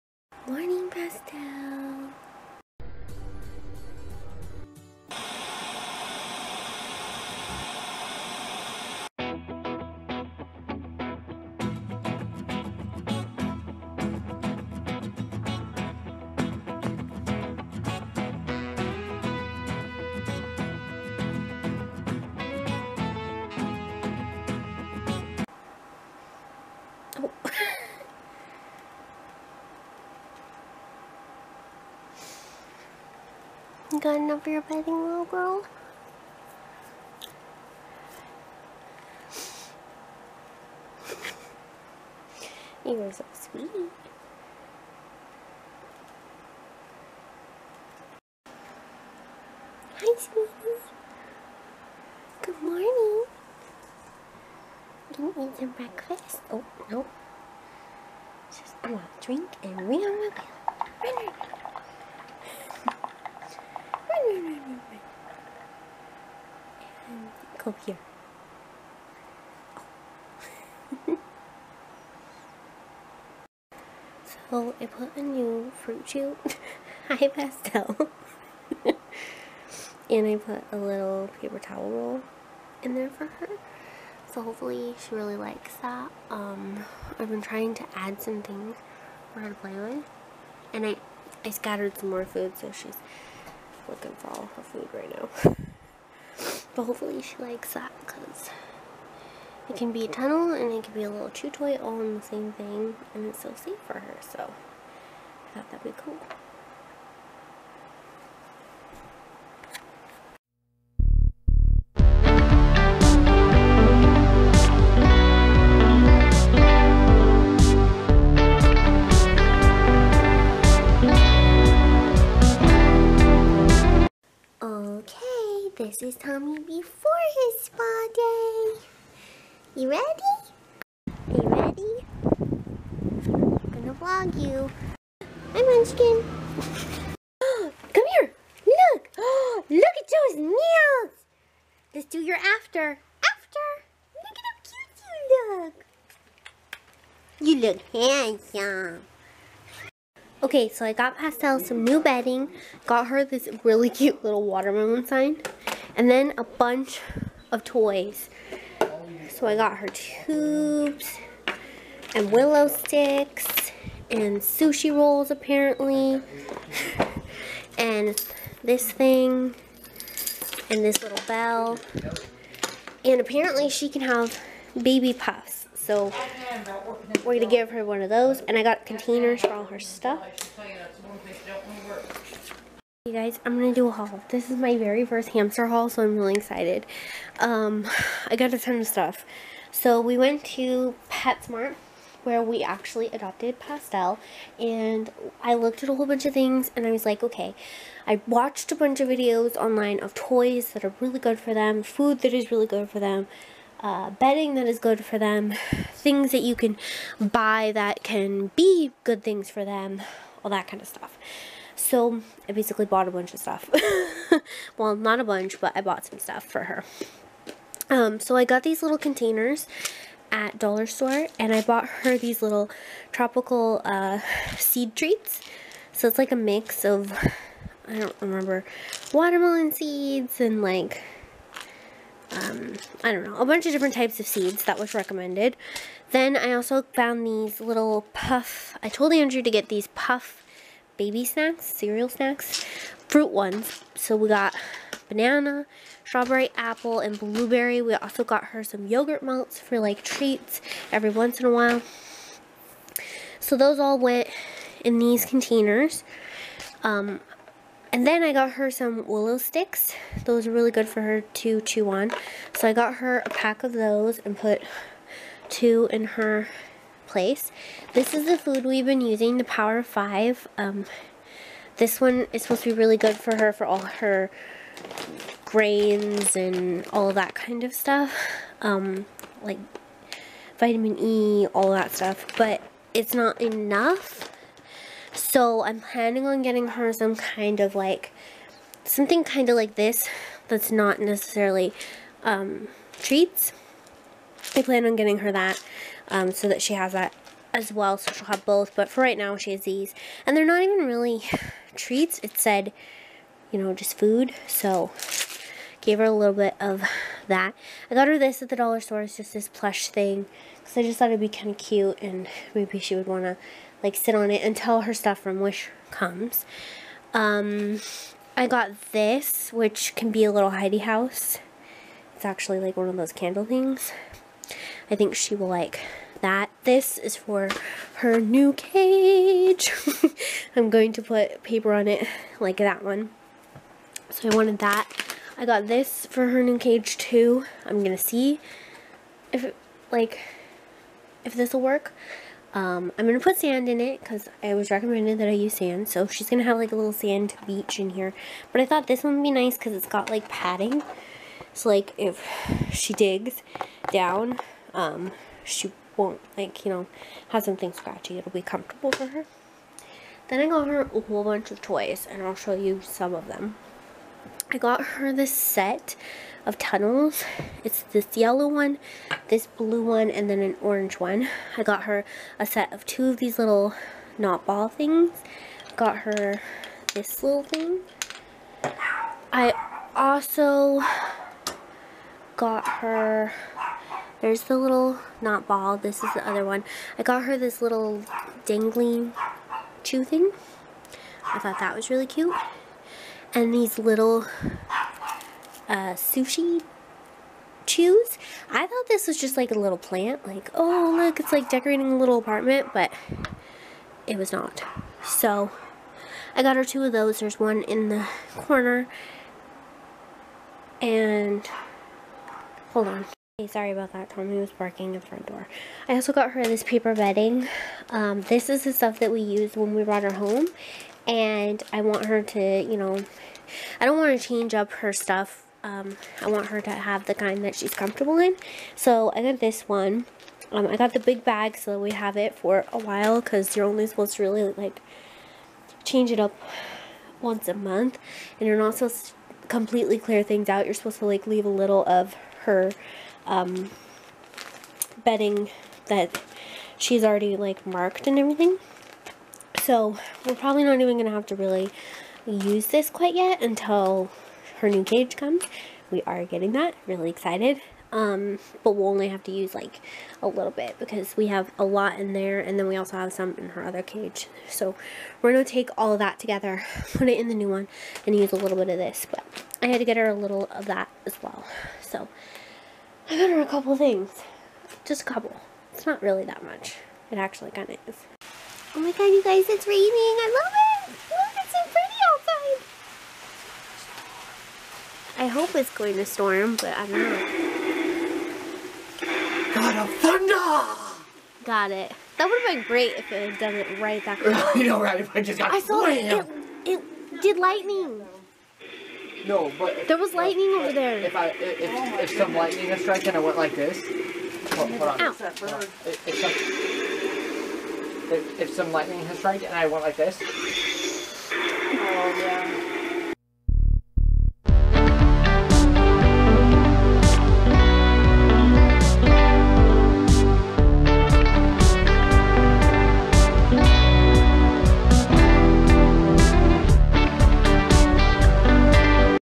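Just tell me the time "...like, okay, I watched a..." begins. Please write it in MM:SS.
03:17.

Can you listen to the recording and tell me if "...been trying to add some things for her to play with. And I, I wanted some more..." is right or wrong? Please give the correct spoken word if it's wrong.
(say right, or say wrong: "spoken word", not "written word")
wrong: "scattered", not "wanted".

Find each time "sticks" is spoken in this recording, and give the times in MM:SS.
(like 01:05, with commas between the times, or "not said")
02:42, 04:19.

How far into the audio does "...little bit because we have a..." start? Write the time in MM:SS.
07:40.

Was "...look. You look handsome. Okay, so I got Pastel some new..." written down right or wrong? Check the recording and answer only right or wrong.
right.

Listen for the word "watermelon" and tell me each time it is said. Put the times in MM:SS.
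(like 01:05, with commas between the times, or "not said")
02:34, 03:49.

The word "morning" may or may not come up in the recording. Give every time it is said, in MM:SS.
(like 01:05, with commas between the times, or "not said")
00:00, 00:52.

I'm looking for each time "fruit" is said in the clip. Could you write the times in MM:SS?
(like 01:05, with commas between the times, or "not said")
01:15, 04:03.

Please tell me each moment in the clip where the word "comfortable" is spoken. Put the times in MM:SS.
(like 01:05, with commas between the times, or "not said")
05:58, 07:07.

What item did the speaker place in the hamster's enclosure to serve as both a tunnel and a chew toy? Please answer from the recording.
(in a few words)
paper towel roll.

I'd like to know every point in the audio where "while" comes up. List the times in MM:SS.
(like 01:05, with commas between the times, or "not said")
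04:11, 07:12.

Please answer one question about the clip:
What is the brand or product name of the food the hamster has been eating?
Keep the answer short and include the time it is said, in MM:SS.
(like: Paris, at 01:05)
Power 5, at 04:29.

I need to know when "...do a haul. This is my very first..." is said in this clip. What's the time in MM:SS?
03:03.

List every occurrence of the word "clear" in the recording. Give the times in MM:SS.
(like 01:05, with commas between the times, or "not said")
07:19.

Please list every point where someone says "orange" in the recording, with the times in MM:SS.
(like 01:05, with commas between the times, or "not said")
06:10.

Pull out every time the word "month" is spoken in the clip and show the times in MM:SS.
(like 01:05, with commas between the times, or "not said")
07:17.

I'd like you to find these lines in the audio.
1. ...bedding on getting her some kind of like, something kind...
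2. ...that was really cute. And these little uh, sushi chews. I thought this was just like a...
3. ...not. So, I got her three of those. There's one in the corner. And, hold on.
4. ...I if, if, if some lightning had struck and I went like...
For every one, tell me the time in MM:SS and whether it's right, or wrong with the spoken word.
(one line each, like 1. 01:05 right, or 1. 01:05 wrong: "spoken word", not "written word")
1. 04:45 wrong: "planning", not "bedding"
2. 06:31 right
3. 06:44 wrong: "two", not "three"
4. 08:21 right.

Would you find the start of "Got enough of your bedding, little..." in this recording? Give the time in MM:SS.
00:33.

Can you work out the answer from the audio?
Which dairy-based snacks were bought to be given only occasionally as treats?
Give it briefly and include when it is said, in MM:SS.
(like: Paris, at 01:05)
yogurt melts, at 04:08.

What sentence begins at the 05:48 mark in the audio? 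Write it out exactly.
But I thought this one would be nice because it's got like padding.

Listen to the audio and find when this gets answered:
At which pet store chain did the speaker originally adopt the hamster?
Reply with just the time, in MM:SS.
03:11.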